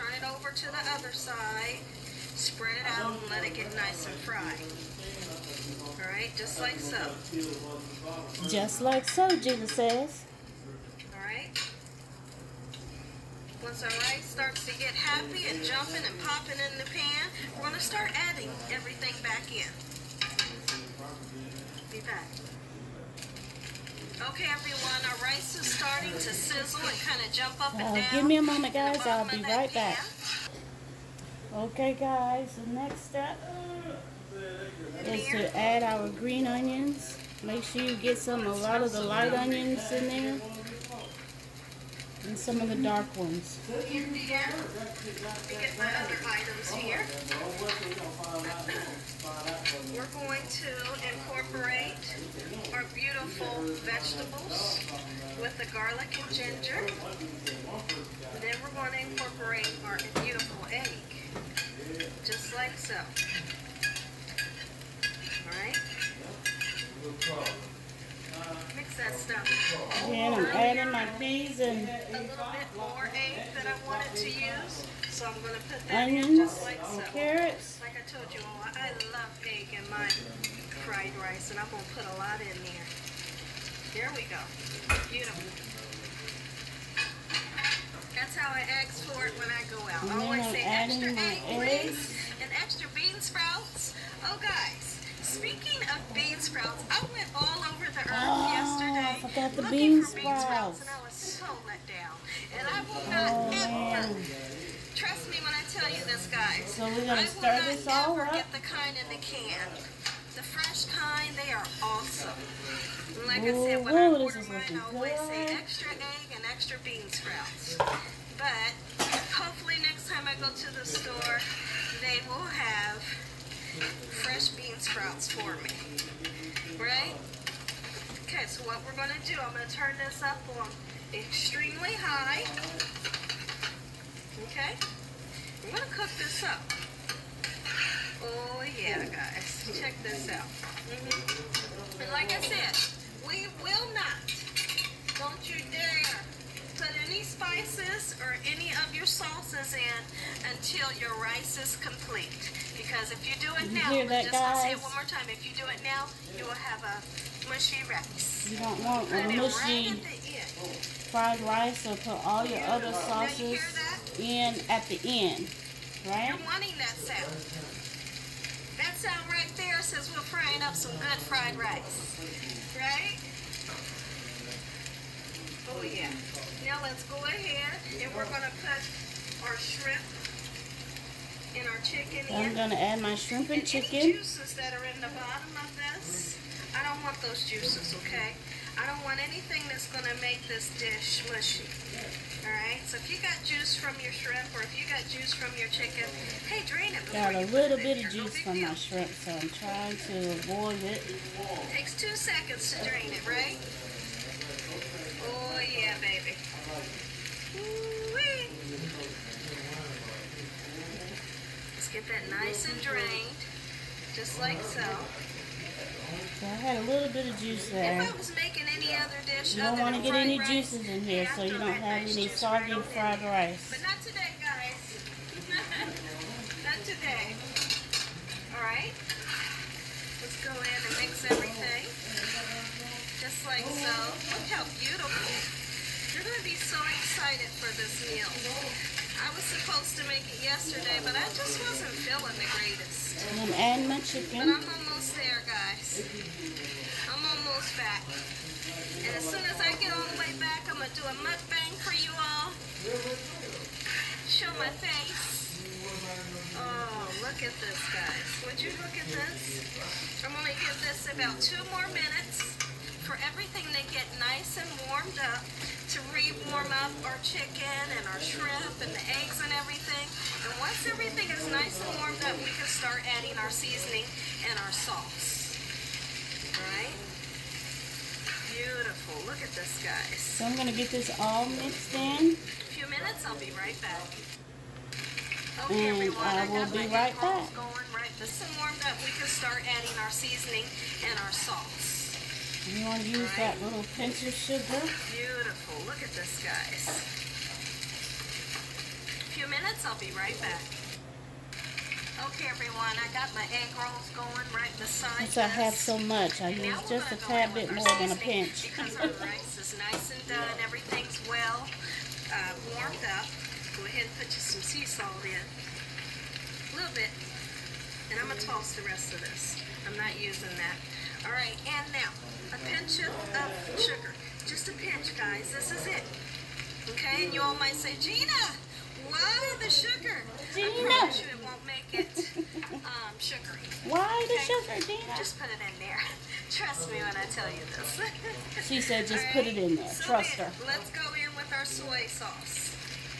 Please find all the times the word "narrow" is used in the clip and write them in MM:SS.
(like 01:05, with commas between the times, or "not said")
not said.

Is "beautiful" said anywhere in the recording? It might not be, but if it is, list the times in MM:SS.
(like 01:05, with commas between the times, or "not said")
00:52, 01:00, 01:25, 03:54, 04:38, 04:54.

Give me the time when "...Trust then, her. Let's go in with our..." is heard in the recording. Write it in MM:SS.
05:40.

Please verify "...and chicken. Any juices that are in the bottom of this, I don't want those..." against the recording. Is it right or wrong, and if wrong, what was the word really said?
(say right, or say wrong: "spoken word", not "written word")
right.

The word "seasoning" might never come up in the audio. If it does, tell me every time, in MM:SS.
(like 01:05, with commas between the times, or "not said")
04:33, 04:50.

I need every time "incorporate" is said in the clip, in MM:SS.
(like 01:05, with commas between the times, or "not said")
00:51, 00:59.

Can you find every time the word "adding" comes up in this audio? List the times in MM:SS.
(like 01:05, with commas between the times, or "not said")
00:18, 01:10, 04:33, 04:49.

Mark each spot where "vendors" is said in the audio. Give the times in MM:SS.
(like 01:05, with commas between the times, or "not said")
not said.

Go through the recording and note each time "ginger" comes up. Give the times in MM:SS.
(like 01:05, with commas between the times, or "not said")
00:56.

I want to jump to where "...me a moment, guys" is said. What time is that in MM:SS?
00:28.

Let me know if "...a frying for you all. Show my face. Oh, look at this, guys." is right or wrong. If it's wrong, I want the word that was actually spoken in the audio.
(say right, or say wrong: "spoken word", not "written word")
wrong: "mukbang", not "frying".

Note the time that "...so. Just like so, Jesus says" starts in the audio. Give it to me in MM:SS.
00:06.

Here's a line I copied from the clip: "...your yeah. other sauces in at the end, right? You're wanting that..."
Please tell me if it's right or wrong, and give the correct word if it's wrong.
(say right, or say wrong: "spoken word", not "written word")
right.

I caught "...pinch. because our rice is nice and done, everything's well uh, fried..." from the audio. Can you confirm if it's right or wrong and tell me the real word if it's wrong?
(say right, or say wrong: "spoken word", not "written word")
wrong: "warmed", not "fried".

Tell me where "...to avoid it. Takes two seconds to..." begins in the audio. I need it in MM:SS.
03:20.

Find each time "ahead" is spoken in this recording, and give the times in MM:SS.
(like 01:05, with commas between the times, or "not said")
02:57, 05:13.